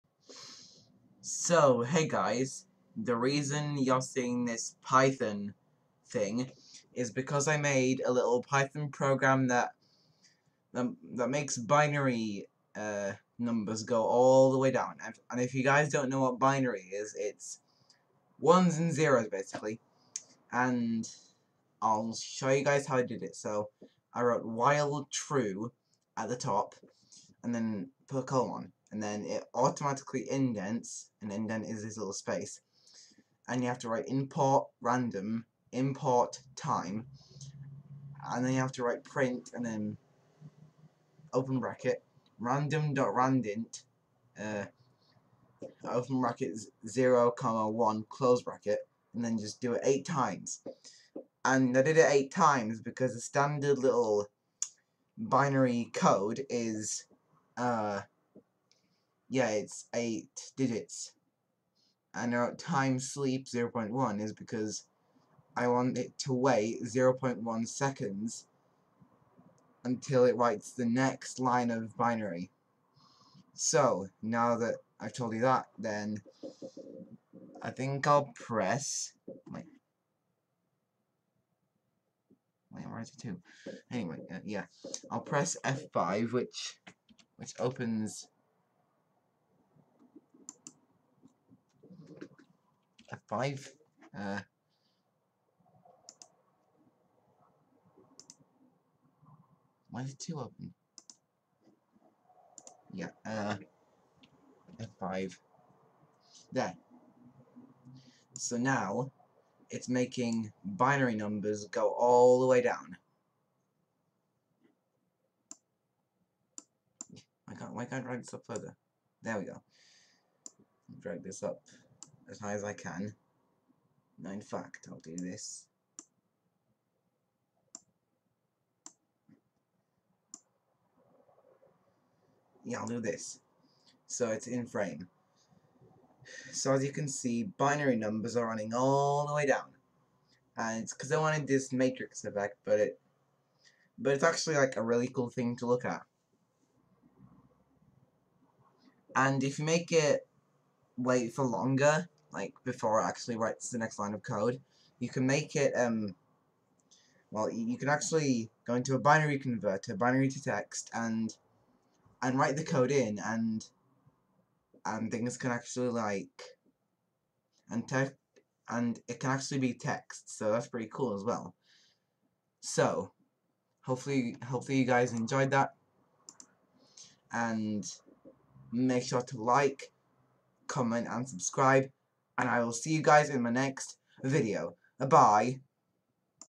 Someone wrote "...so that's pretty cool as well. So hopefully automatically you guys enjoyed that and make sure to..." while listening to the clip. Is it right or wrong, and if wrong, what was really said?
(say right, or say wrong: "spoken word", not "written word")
wrong: "hopefully", not "automatically".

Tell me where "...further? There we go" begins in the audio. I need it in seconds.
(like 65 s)
118 s.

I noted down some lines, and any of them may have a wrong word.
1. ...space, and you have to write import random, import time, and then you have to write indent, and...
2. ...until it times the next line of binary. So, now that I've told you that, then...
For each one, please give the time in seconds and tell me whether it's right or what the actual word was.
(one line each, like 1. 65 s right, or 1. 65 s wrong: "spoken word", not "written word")
1. 32 s wrong: "print", not "indent"
2. 69 s wrong: "writes", not "times".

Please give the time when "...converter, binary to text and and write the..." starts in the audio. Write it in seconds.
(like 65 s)
159 s.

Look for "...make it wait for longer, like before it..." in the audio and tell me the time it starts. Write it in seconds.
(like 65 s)
149 s.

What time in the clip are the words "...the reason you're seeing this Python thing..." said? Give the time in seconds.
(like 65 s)
2 s.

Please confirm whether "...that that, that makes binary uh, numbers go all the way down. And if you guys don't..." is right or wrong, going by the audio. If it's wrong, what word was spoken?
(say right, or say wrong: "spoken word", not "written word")
right.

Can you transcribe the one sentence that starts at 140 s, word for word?
And it's because I wanted this matrix effect, but it but it's actually like a really cool thing to look at.